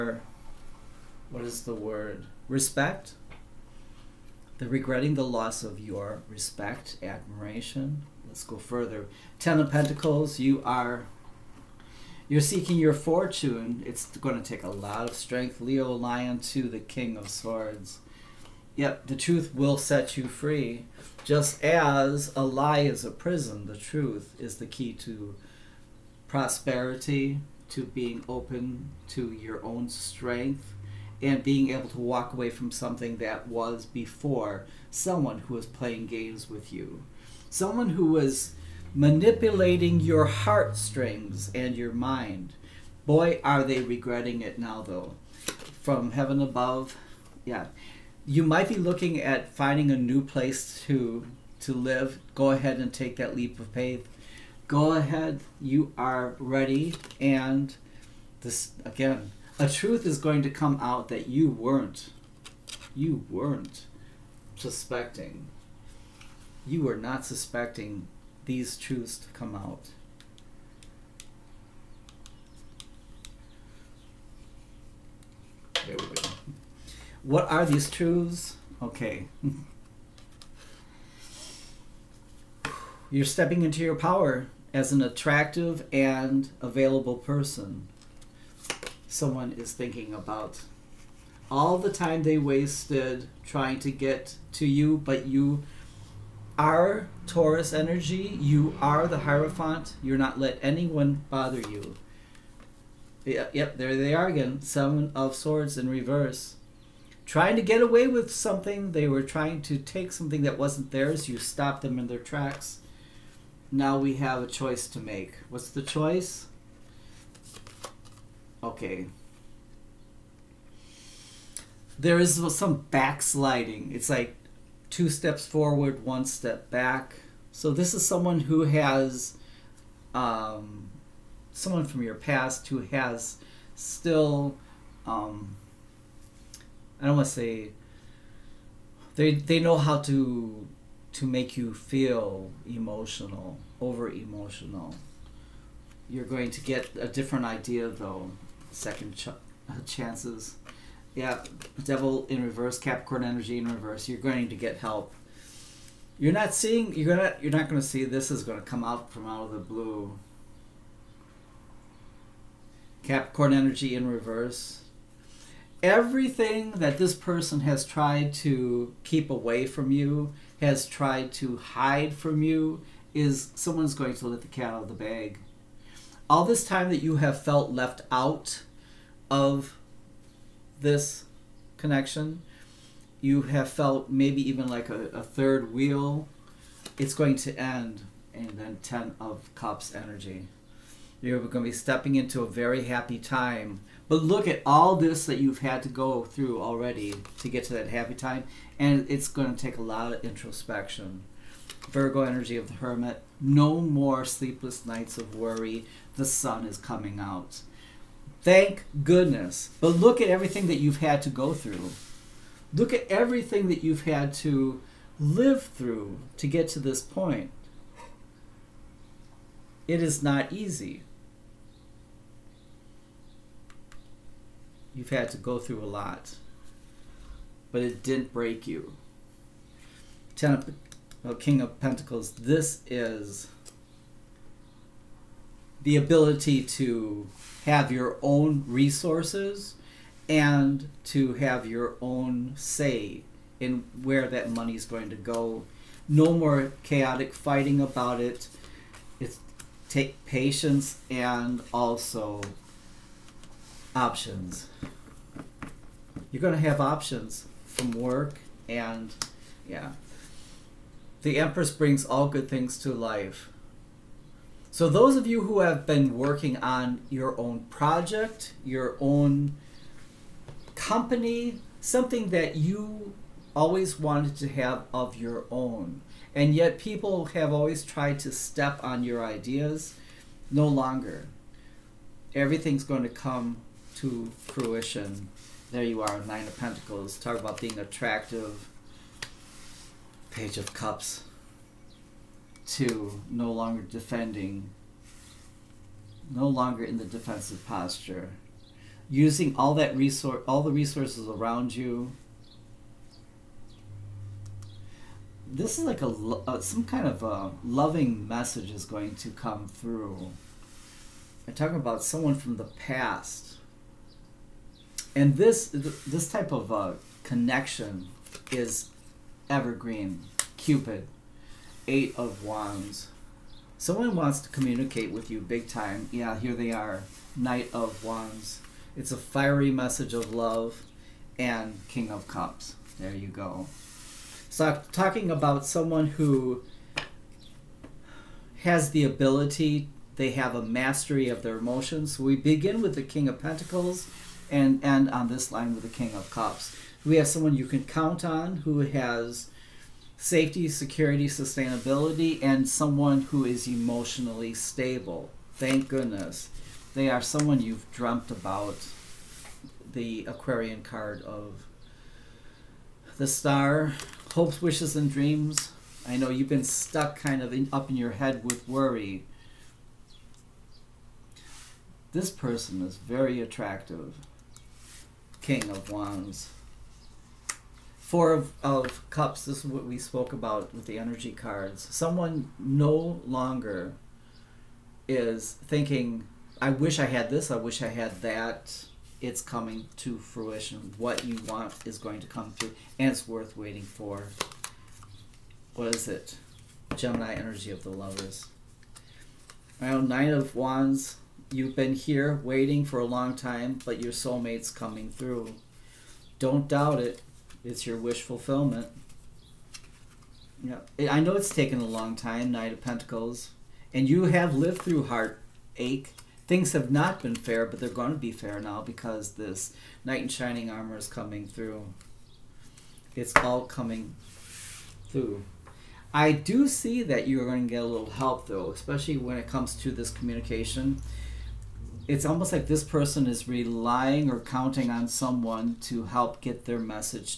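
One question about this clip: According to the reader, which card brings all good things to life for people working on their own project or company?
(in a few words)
The Empress.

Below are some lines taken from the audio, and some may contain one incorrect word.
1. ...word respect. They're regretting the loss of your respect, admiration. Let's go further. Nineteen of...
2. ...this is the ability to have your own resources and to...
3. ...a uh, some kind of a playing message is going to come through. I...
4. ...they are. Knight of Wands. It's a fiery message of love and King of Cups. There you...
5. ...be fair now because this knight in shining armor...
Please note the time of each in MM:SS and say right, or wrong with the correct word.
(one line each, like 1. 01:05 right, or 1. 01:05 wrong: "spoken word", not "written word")
1. 00:01 wrong: "Ten", not "Nineteen"
2. 03:52 right
3. 05:06 wrong: "loving", not "playing"
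4. 05:26 right
5. 06:58 right.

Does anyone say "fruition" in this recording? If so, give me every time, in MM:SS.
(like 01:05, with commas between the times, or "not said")
04:44, 06:30.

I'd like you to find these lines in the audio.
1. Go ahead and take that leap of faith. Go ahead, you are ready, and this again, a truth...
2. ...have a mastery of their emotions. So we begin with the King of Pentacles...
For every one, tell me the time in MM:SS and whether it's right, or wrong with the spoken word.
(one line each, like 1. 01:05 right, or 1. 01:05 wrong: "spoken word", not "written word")
1. 00:52 right
2. 05:40 right.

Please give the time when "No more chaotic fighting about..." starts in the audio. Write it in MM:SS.
04:06.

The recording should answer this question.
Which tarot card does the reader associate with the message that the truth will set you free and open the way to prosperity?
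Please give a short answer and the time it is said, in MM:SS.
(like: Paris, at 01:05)
King of Swords, at 00:16.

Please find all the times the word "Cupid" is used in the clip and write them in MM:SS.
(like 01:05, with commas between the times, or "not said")
05:20.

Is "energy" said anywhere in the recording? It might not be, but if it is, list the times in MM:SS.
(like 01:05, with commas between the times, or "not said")
01:37, 02:33, 02:43, 03:09, 03:22, 06:20, 06:37.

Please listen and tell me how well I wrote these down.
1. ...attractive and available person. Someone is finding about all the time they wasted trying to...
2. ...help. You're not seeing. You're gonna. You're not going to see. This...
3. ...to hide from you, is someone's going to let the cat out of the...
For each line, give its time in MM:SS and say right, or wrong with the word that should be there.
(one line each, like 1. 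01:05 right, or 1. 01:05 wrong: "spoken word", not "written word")
1. 01:25 wrong: "thinking", not "finding"
2. 02:34 right
3. 02:51 right.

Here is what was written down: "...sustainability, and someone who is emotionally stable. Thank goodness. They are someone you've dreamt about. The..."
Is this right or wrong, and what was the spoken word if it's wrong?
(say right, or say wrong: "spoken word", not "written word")
right.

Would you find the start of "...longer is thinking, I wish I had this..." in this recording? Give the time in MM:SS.
06:23.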